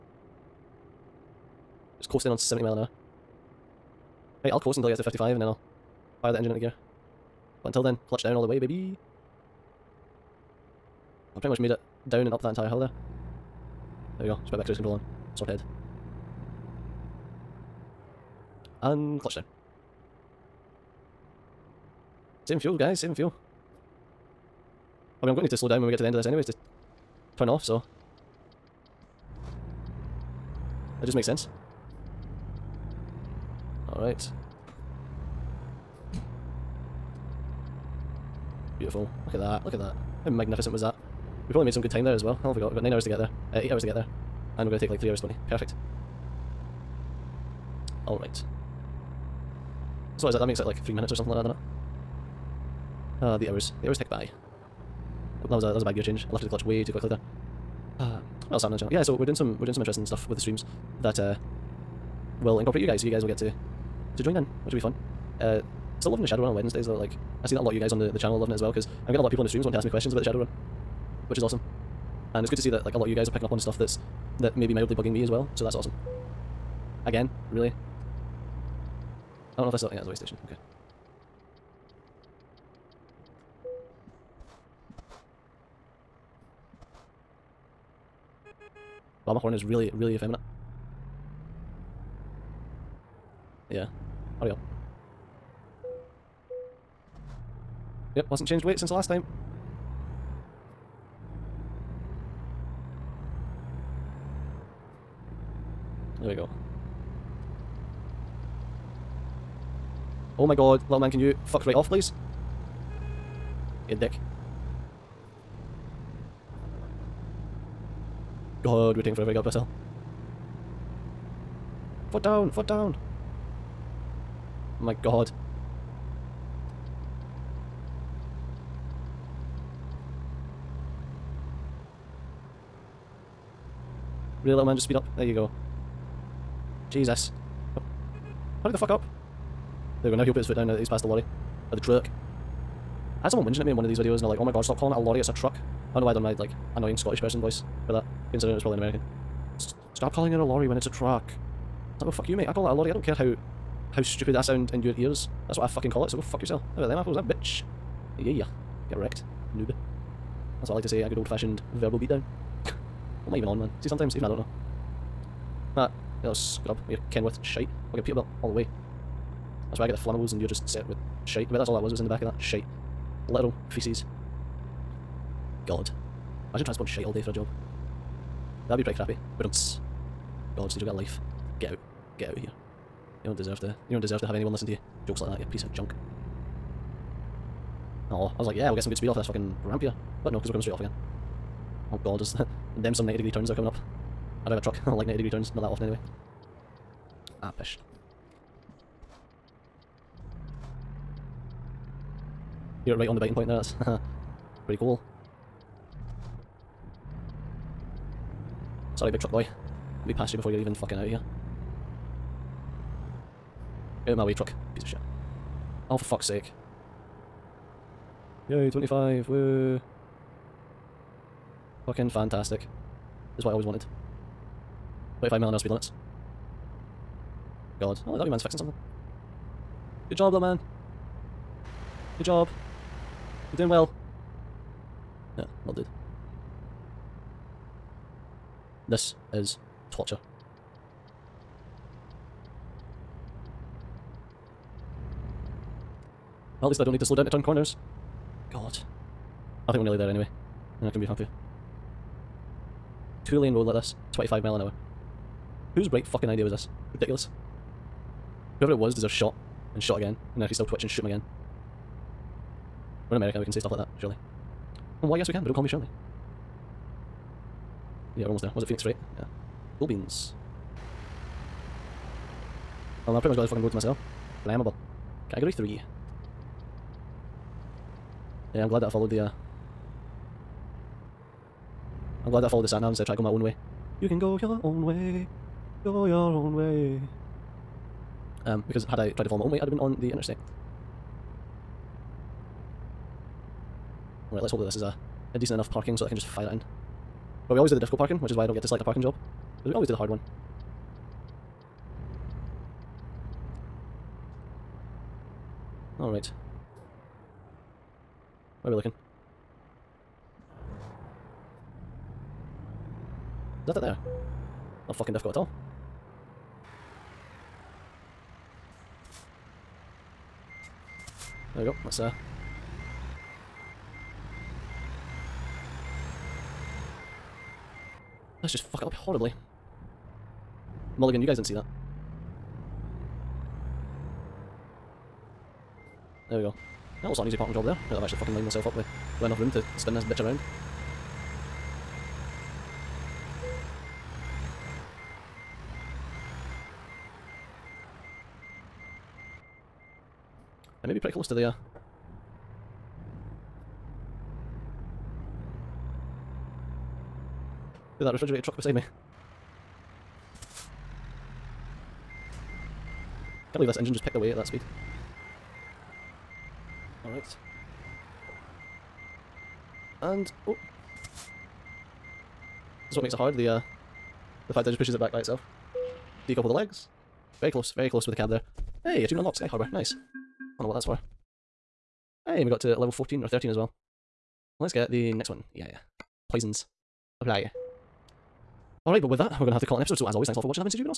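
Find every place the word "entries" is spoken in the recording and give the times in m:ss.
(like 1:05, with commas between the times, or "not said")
not said.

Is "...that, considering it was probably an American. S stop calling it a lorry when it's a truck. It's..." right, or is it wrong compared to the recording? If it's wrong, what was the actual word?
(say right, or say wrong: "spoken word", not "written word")
right.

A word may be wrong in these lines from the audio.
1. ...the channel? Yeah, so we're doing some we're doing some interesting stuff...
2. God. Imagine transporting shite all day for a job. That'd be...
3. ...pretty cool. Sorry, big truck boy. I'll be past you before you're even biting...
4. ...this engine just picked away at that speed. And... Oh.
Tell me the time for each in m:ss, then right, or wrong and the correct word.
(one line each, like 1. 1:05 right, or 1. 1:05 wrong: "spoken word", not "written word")
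1. 0:58 right
2. 2:55 right
3. 3:24 wrong: "fucking", not "biting"
4. 6:03 right.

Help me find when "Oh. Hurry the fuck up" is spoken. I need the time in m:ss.
2:17.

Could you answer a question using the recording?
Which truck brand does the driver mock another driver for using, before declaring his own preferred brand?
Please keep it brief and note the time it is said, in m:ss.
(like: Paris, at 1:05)
Kenworth, at 2:47.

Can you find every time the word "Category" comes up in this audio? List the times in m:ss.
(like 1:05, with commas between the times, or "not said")
4:35.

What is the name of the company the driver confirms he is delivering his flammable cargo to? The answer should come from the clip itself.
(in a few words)
Phoenix Freight.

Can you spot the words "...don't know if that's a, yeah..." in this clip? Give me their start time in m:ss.
1:19.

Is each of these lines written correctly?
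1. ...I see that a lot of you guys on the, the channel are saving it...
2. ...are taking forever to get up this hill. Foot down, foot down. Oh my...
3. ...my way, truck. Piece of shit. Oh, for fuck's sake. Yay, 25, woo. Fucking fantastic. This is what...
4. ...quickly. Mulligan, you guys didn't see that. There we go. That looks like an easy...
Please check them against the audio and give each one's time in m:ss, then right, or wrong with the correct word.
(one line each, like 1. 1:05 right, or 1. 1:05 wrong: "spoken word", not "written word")
1. 1:07 wrong: "loving", not "saving"
2. 1:58 right
3. 3:34 right
4. 5:28 wrong: "horribly", not "quickly".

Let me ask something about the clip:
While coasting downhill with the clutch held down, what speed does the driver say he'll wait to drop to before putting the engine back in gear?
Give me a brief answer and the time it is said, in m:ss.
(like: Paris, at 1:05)
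55, at 0:05.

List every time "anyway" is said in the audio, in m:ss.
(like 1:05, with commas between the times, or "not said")
0:26, 3:15, 4:10.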